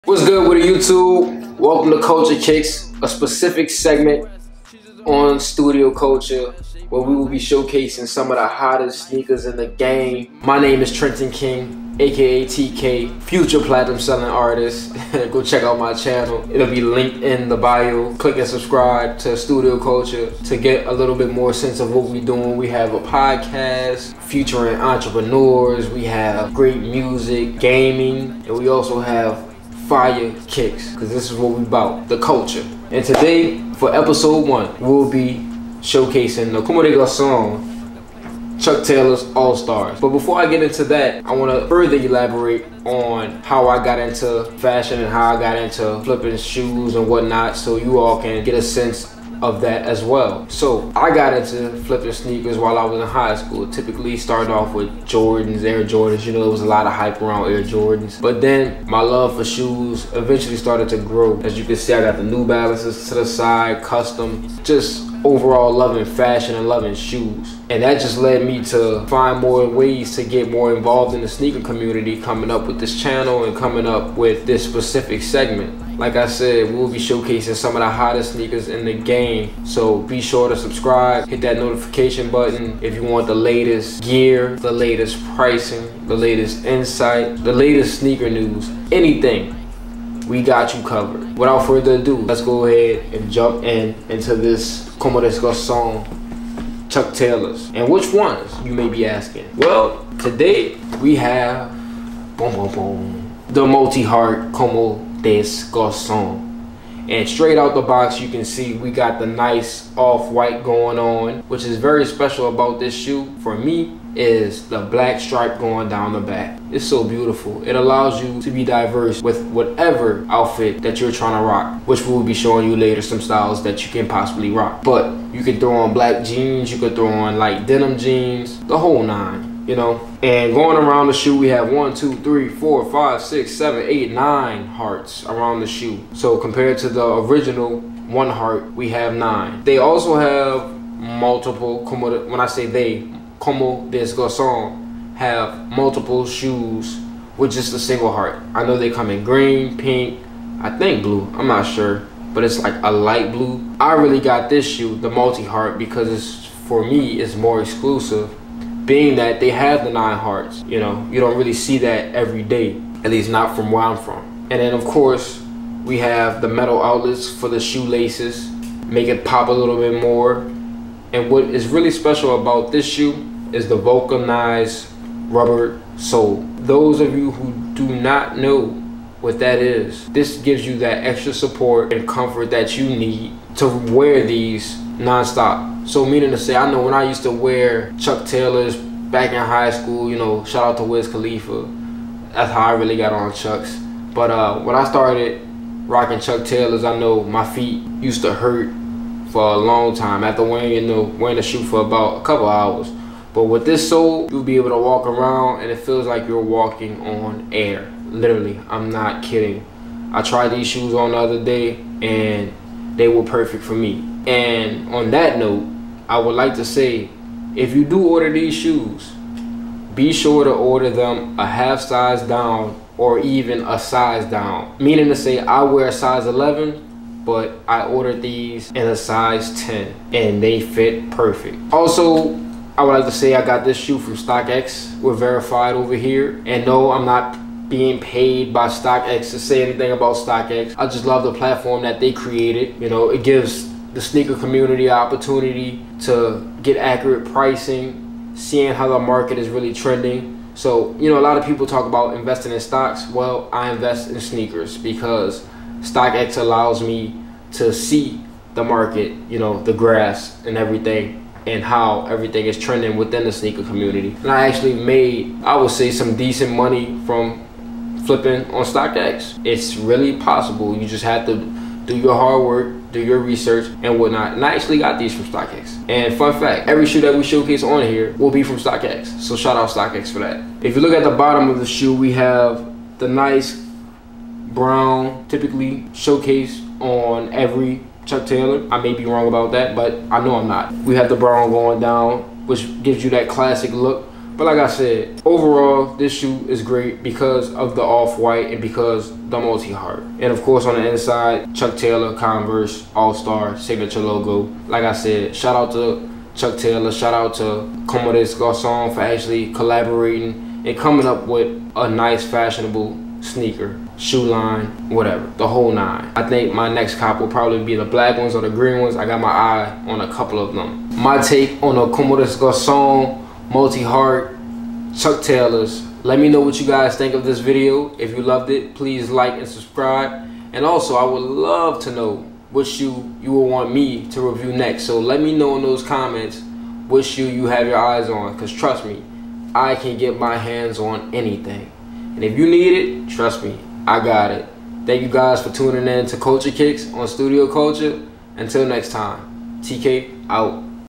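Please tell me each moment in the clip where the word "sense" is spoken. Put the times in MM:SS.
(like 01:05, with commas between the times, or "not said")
00:21, 00:48.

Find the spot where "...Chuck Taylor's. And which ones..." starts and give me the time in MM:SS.
01:36.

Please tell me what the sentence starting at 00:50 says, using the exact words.
So I got into flipping sneakers while I was in high school.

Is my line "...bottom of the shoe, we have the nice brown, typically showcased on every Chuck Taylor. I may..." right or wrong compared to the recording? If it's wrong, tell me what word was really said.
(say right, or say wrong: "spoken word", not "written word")
right.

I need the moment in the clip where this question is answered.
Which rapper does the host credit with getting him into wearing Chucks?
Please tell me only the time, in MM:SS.
03:10.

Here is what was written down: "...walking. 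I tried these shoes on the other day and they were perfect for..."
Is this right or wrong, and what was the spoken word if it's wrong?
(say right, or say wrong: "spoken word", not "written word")
wrong: "kidding", not "walking".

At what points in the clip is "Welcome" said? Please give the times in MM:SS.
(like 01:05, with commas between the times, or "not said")
00:01.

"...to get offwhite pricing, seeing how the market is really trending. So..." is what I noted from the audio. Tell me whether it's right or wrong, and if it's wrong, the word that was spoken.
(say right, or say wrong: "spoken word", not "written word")
wrong: "accurate", not "offwhite".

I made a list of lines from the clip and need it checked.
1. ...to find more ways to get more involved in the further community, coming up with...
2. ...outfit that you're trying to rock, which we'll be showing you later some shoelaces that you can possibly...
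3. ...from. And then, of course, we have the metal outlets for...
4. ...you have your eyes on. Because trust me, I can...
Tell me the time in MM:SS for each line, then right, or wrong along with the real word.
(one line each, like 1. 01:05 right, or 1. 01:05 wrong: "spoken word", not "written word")
1. 01:08 wrong: "sneaker", not "further"
2. 02:00 wrong: "styles", not "shoelaces"
3. 02:43 right
4. 05:37 right.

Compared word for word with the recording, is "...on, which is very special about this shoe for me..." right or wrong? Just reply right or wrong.
right.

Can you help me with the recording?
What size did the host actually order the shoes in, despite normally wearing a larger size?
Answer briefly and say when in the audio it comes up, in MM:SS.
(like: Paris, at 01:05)
10, at 03:48.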